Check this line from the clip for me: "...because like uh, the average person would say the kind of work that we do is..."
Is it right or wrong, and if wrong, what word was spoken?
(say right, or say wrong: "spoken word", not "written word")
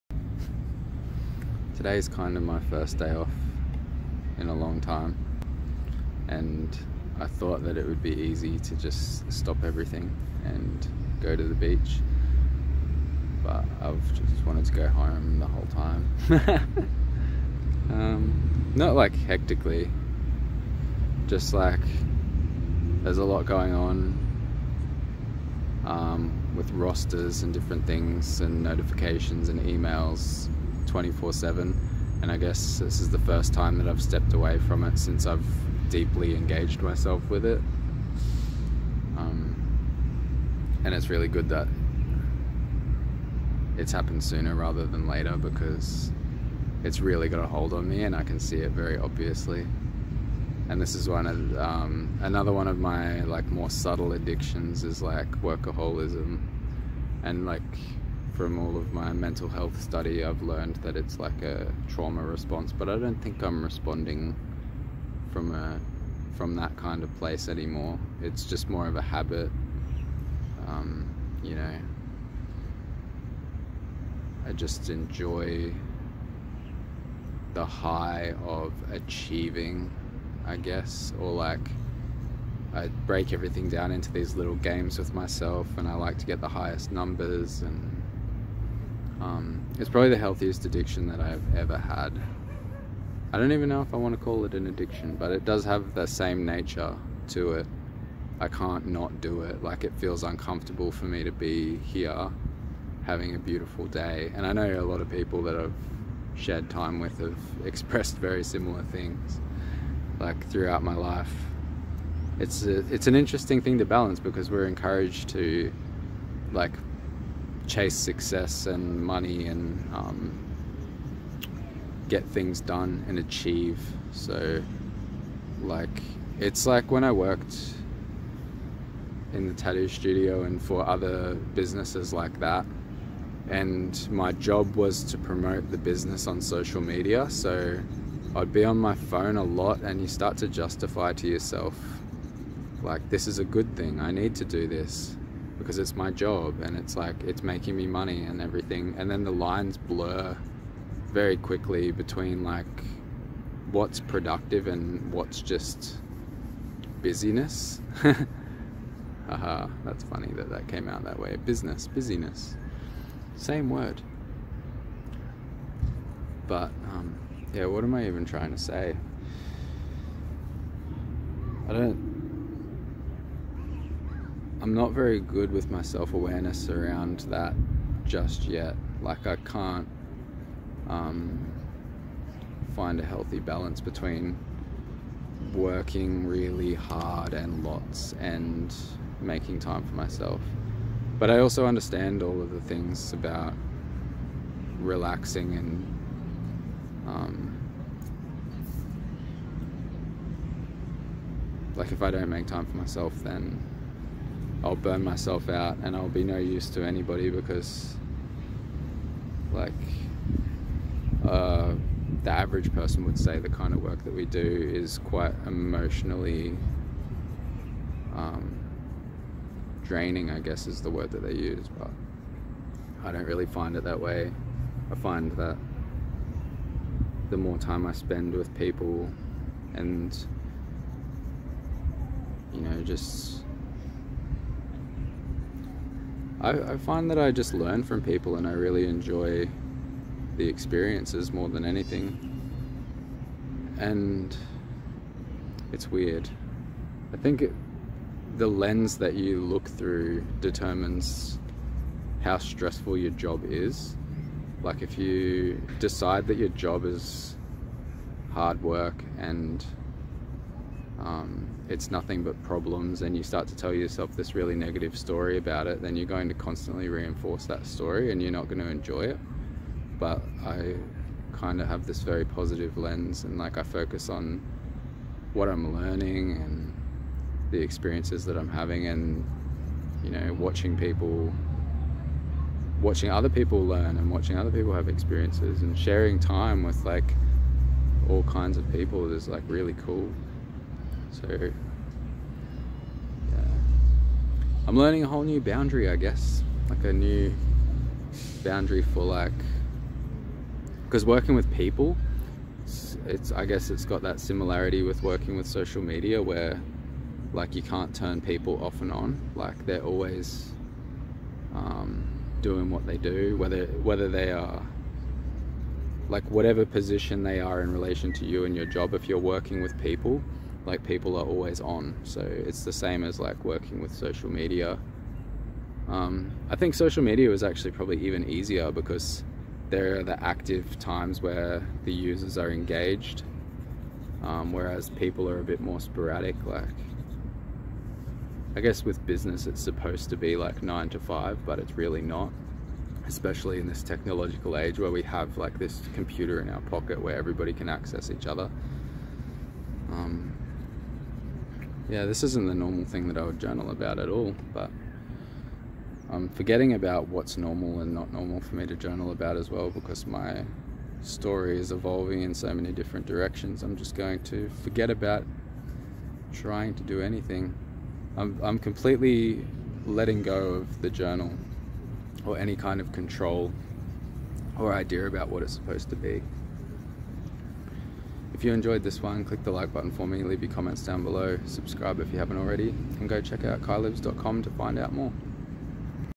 right.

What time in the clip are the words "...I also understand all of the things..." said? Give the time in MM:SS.
03:11.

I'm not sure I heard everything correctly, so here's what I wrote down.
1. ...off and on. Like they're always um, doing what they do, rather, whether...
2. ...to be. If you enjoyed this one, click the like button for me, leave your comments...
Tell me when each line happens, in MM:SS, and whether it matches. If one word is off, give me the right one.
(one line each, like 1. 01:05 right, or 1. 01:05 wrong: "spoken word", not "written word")
1. 05:08 wrong: "whether", not "rather"
2. 06:15 right.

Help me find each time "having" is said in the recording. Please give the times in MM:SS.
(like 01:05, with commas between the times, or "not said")
01:43, 04:38.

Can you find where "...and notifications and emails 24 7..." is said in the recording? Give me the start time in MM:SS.
00:28.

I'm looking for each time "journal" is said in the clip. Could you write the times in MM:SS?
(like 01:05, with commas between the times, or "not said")
05:53, 05:58, 06:10.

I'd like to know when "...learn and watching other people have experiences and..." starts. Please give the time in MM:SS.
04:43.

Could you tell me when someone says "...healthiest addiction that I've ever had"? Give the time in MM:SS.
01:30.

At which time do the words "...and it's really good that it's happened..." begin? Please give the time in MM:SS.
00:40.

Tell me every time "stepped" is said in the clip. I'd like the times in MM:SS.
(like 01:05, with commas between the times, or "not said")
00:34.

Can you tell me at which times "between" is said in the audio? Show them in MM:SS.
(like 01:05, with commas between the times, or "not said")
02:31, 03:03.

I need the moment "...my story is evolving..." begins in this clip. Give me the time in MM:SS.
06:00.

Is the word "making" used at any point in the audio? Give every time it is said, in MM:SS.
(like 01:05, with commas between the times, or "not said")
02:27, 03:09.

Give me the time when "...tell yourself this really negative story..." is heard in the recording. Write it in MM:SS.
04:23.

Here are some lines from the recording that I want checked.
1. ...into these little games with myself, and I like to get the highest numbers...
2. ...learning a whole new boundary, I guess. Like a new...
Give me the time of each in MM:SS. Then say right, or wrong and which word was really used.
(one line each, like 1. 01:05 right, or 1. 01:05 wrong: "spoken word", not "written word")
1. 01:23 right
2. 04:54 right.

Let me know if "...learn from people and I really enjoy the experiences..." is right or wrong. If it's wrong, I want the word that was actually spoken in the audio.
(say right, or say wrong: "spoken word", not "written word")
right.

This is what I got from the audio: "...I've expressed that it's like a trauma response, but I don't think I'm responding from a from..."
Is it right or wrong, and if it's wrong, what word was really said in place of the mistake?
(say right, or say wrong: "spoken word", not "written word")
wrong: "learned", not "expressed".